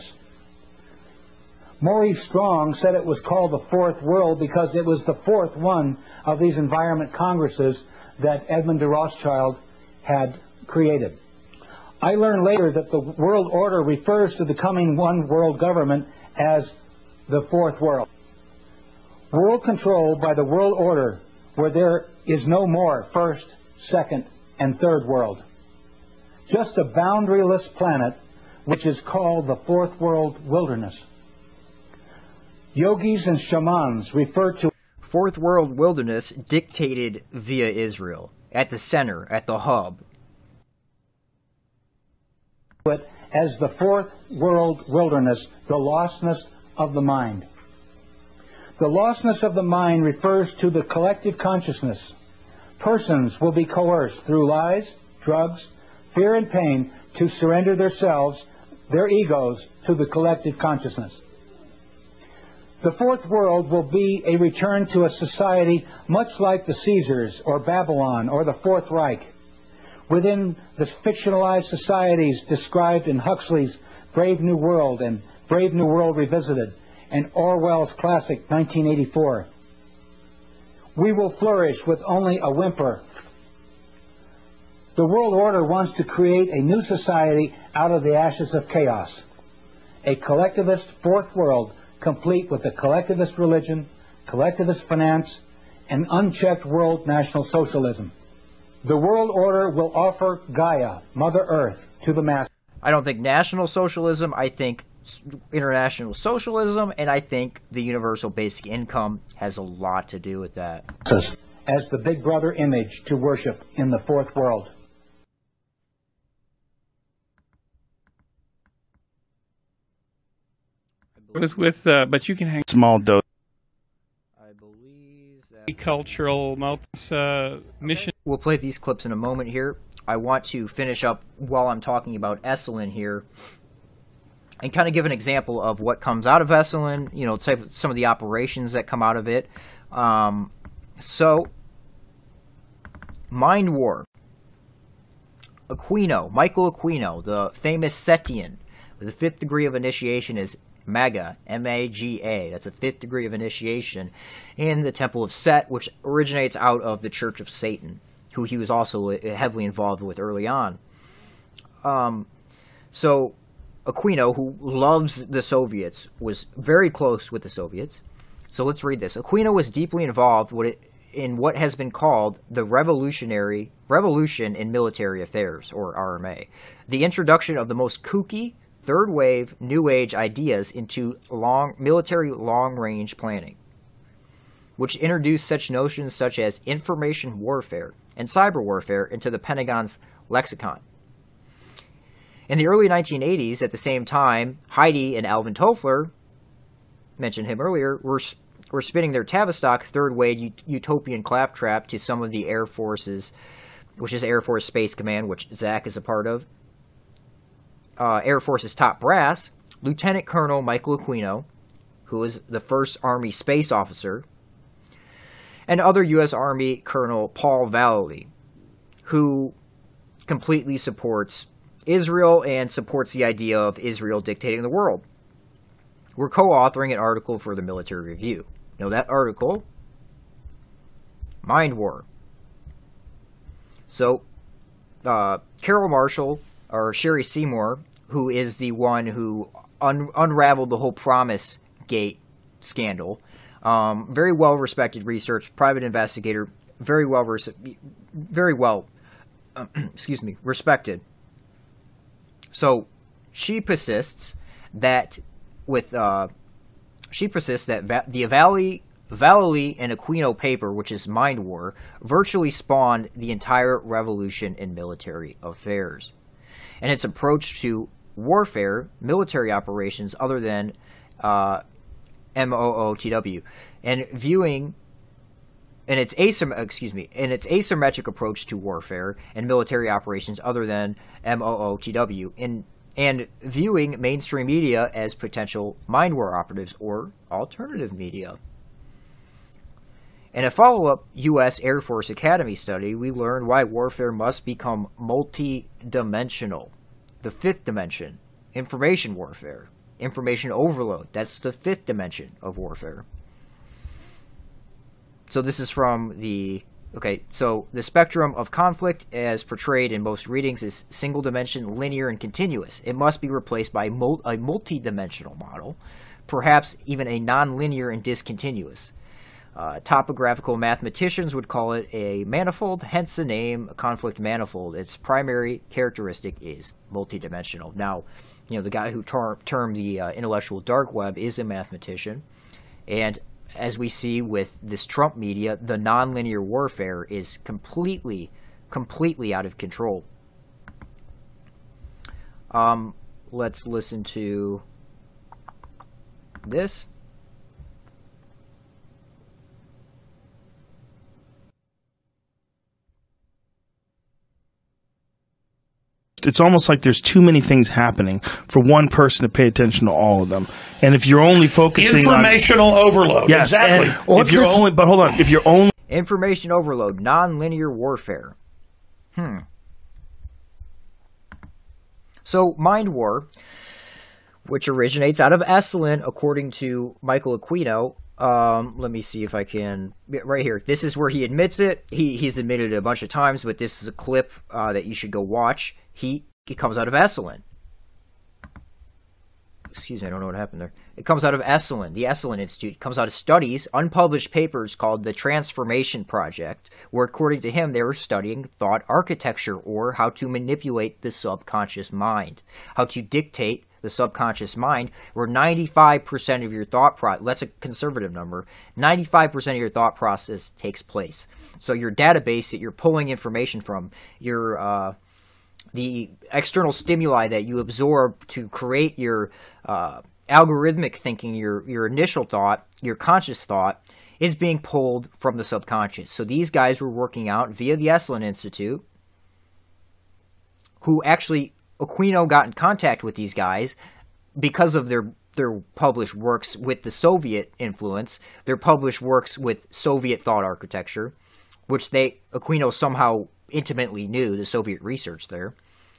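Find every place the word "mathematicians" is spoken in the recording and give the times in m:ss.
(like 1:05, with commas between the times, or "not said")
5:20, 5:31.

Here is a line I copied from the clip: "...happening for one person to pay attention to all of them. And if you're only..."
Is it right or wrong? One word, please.
right.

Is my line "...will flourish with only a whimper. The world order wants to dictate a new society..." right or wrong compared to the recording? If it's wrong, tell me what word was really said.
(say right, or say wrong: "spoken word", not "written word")
wrong: "create", not "dictate".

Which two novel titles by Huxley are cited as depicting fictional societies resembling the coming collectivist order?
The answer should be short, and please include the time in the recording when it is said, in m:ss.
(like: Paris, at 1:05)
Brave New World and Brave New World Revisited, at 1:14.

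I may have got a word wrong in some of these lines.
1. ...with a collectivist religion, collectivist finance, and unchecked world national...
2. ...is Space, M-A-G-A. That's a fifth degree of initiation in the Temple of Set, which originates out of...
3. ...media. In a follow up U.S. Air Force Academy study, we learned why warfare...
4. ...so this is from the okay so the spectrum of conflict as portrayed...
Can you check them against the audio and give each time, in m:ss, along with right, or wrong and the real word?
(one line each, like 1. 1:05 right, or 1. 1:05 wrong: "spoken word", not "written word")
1. 1:32 right
2. 2:30 wrong: "Maga", not "Space"
3. 4:47 right
4. 5:05 right.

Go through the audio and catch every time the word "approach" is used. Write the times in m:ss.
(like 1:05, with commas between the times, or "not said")
4:27, 4:38.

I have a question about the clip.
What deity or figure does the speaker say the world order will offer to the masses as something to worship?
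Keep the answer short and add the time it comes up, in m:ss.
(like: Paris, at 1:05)
Gaia, at 1:40.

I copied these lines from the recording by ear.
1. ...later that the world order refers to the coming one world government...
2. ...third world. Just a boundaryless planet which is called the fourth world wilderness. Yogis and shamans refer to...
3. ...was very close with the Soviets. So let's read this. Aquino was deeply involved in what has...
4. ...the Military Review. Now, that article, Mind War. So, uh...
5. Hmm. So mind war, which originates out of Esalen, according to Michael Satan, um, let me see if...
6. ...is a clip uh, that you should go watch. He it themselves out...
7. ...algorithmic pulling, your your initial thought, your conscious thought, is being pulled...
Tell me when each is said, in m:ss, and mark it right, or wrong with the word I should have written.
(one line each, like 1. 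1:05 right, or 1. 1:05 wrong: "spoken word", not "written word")
1. 0:12 right
2. 0:24 right
3. 2:46 right
4. 3:47 right
5. 6:09 wrong: "Aquino", not "Satan"
6. 6:23 wrong: "comes", not "themselves"
7. 7:00 wrong: "thinking", not "pulling".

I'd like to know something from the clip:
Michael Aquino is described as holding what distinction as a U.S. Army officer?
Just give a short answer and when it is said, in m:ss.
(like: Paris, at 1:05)
first Army space officer, at 3:32.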